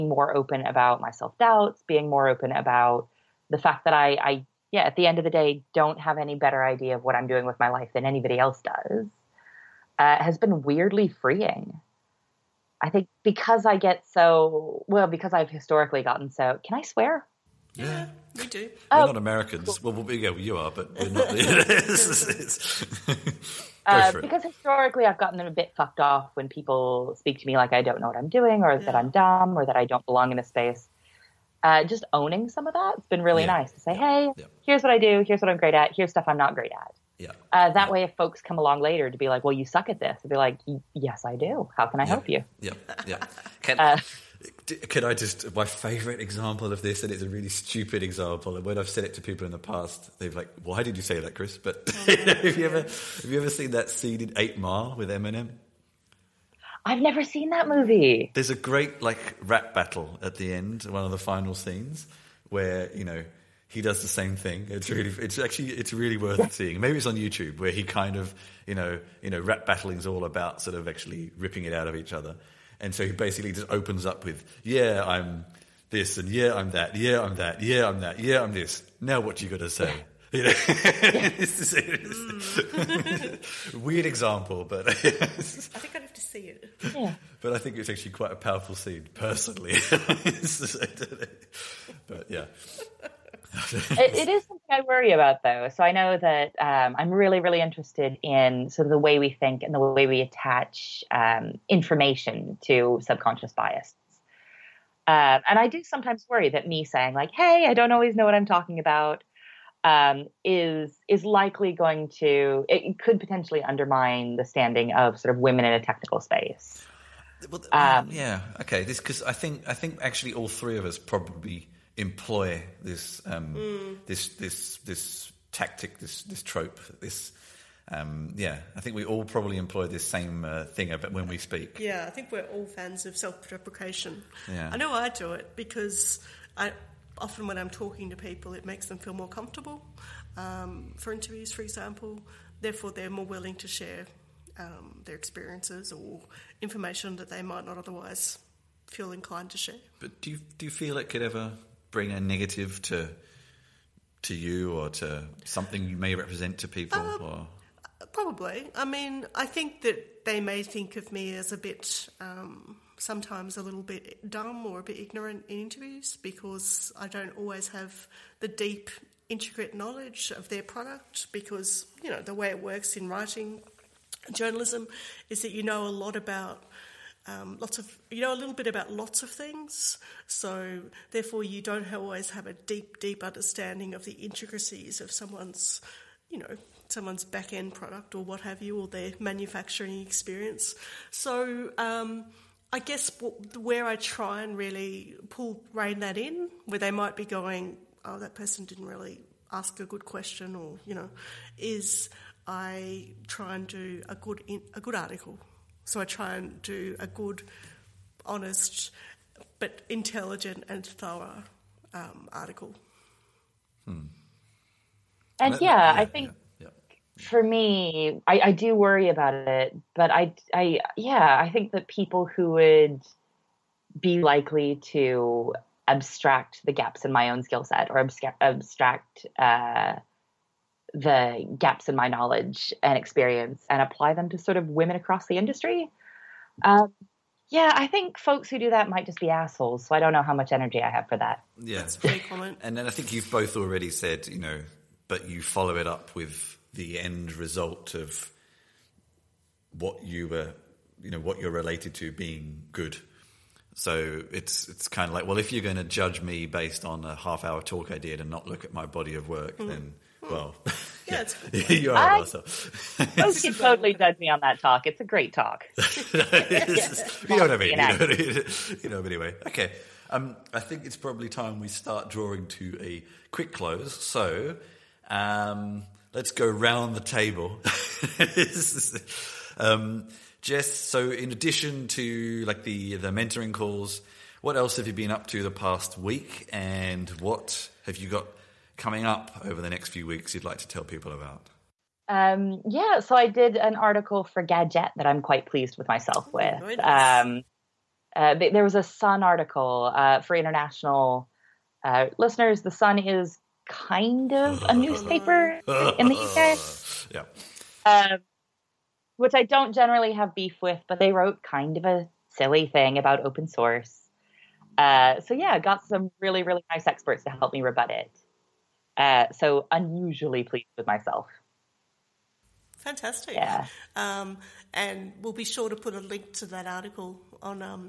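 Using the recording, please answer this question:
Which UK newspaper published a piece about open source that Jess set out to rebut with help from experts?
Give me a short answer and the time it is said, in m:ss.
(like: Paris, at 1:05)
The Sun, at 5:02.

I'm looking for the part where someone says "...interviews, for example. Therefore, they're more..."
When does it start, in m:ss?
2:21.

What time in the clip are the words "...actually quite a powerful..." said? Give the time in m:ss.
1:27.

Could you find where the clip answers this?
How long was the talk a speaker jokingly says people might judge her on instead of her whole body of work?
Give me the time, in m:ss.
4:17.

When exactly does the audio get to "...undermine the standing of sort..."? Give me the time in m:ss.
1:53.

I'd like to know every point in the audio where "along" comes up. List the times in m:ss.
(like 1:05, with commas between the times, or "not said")
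0:38.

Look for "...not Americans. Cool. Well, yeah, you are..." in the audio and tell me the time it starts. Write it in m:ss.
0:19.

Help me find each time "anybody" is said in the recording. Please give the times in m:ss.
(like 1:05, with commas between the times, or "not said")
0:08.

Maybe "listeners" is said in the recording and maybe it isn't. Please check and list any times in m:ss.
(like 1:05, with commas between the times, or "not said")
5:02.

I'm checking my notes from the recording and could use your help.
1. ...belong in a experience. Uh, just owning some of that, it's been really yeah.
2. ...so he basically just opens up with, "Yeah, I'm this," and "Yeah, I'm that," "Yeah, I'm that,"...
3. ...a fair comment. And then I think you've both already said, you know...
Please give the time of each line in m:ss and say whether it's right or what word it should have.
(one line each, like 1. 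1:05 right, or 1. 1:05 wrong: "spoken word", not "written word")
1. 0:30 wrong: "space", not "experience"
2. 1:12 right
3. 4:01 right.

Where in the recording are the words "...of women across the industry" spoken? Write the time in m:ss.
3:54.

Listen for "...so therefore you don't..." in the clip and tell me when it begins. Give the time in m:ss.
3:00.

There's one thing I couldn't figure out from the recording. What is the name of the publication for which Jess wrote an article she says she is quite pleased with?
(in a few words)
Gadget.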